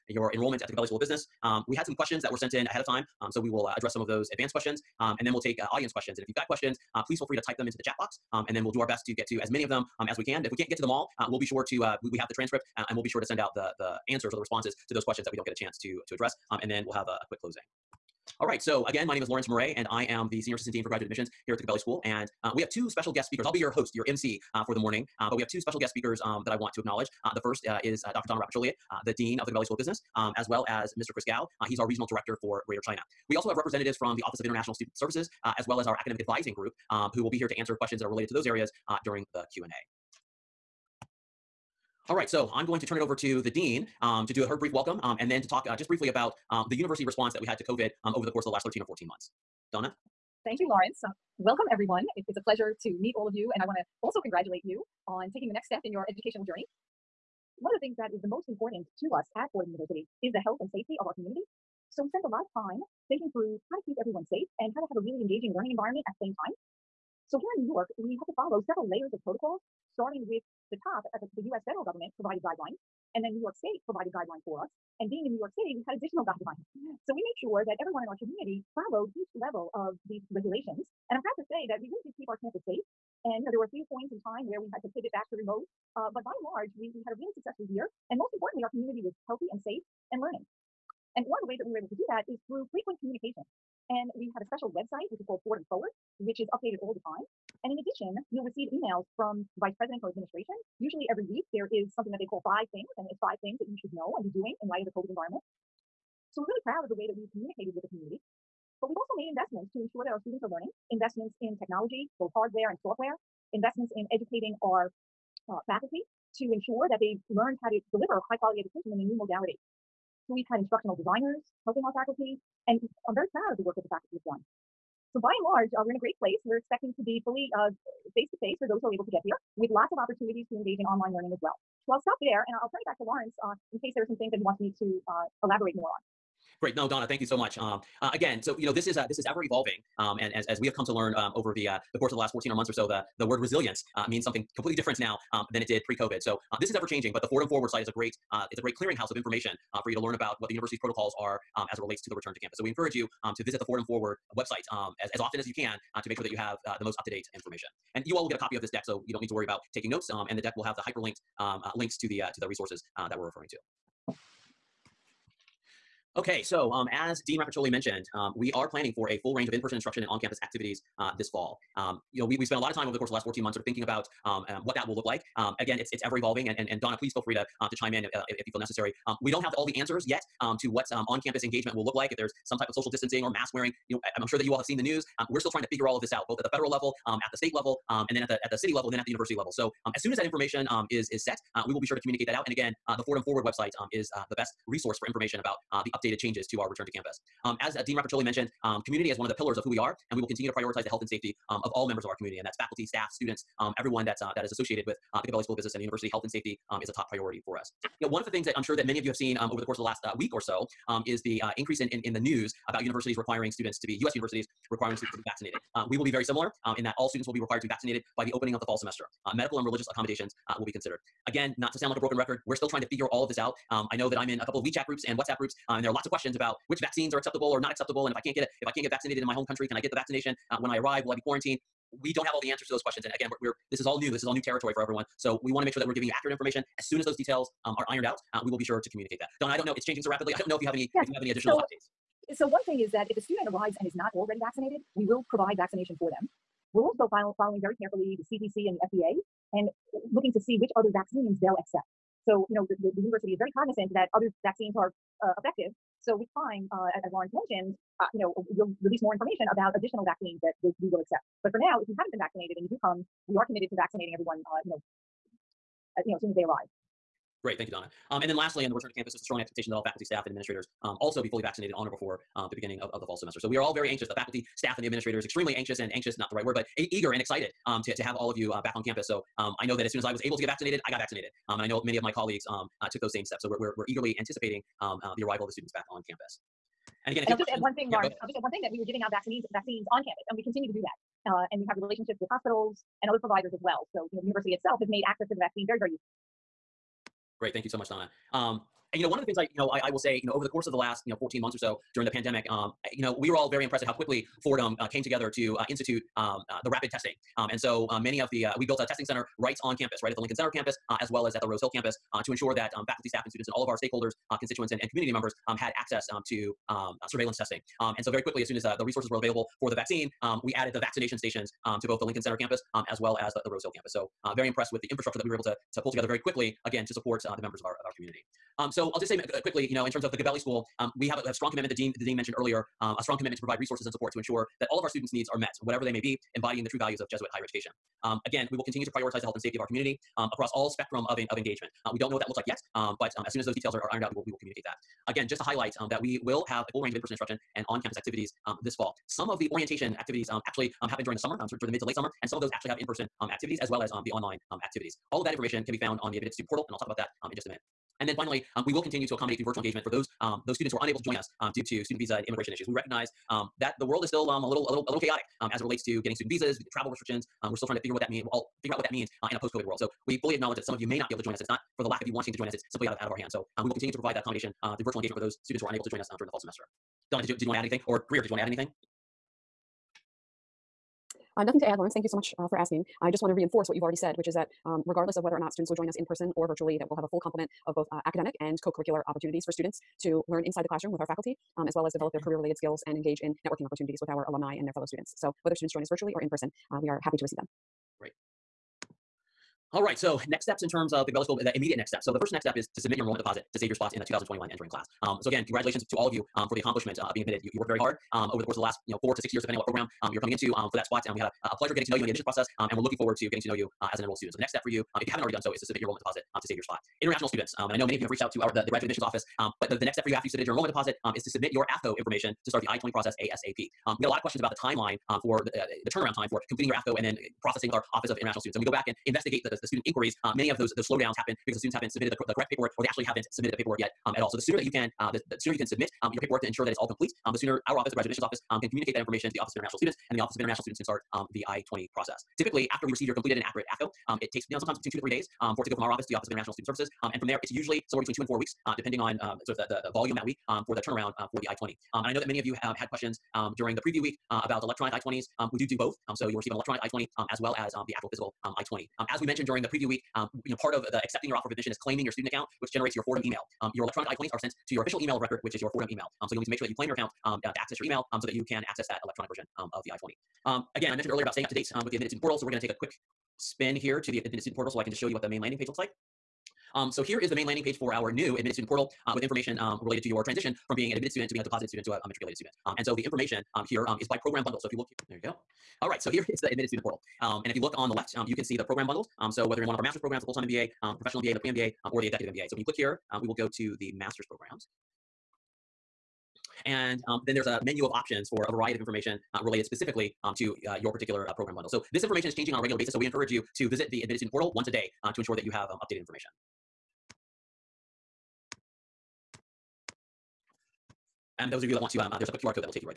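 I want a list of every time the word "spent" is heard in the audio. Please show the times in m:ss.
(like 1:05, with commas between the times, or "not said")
1:02, 2:52.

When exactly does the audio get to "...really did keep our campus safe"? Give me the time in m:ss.
1:21.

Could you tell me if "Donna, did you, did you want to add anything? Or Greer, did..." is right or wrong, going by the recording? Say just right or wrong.
right.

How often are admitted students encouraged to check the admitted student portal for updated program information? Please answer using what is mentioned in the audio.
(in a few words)
once a day.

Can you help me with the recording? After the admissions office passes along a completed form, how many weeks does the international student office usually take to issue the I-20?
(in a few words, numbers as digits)
2 to 4 weeks.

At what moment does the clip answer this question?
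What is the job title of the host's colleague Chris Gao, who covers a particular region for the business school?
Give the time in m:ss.
0:31.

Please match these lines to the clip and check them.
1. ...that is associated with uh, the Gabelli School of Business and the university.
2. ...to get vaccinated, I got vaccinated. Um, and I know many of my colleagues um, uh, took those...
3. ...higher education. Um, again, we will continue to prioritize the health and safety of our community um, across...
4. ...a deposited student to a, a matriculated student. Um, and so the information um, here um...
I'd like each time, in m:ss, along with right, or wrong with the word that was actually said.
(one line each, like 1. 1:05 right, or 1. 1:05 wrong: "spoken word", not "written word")
1. 3:24 right
2. 4:40 right
3. 5:37 right
4. 8:01 right.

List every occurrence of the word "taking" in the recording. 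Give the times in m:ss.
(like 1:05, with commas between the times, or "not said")
0:55, 2:39.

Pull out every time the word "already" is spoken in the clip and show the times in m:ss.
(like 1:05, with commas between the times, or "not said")
4:04, 6:23, 6:55.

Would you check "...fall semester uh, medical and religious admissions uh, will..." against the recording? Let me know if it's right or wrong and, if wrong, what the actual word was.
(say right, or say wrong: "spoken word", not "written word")
wrong: "accommodations", not "admissions".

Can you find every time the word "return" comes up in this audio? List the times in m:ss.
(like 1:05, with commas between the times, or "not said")
2:32, 3:16, 4:28.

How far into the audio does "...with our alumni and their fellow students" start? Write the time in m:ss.
6:34.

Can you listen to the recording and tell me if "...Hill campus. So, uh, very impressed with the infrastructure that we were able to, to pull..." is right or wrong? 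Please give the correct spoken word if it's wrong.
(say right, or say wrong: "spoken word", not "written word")
right.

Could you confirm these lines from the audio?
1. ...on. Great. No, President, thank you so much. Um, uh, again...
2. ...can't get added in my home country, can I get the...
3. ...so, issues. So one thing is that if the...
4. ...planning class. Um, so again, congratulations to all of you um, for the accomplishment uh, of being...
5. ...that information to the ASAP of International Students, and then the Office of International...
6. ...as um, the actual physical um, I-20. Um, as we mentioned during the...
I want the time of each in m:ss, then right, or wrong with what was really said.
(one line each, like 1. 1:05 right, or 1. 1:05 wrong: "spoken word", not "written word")
1. 2:15 wrong: "Donna", not "President"
2. 3:48 wrong: "vaccinated", not "added"
3. 4:01 wrong: "updates", not "issues"
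4. 6:44 wrong: "entering", not "planning"
5. 7:18 wrong: "Office", not "ASAP"
6. 7:37 right.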